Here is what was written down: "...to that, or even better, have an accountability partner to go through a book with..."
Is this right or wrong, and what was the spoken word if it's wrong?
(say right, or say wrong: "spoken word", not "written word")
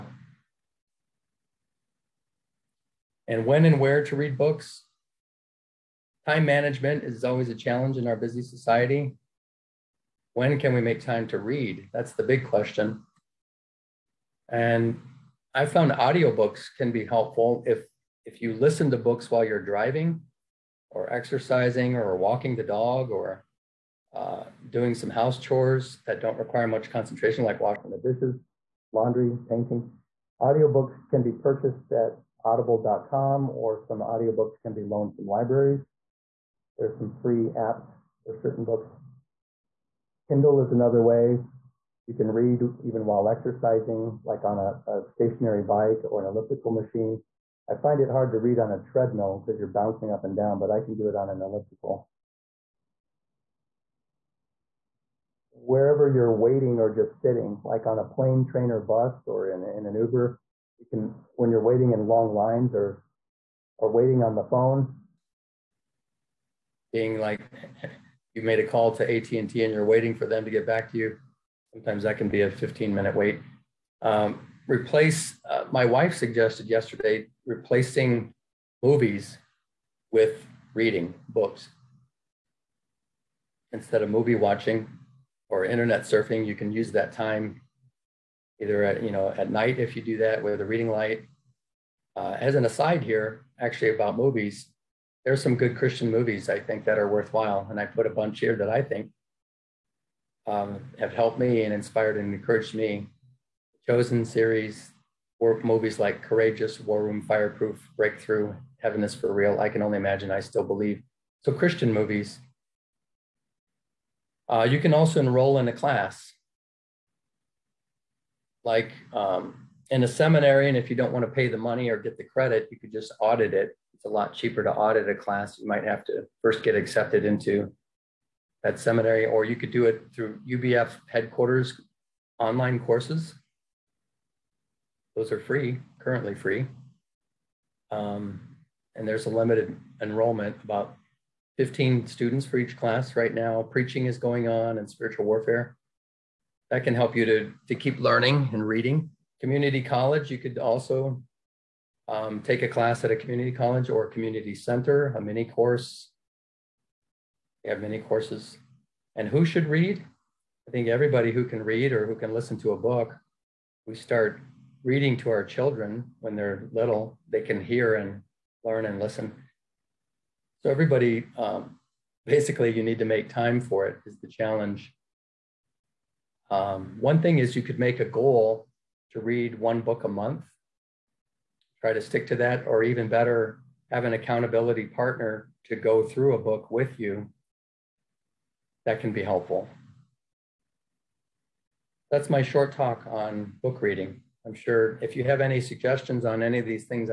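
right.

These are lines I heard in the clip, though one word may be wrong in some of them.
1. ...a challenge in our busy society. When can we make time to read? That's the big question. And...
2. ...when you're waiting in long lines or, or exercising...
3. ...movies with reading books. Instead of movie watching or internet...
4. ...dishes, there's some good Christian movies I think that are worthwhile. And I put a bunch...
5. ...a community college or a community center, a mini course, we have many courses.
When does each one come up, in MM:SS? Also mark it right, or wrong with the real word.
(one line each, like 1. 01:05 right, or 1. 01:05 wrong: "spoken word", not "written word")
1. 00:07 right
2. 01:01 wrong: "waiting", not "exercising"
3. 01:18 right
4. 01:34 wrong: "movies", not "dishes"
5. 02:33 right.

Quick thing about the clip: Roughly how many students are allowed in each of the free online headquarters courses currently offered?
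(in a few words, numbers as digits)
15.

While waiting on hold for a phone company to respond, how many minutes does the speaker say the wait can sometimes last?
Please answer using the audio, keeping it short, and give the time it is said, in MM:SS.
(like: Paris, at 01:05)
15, at 01:12.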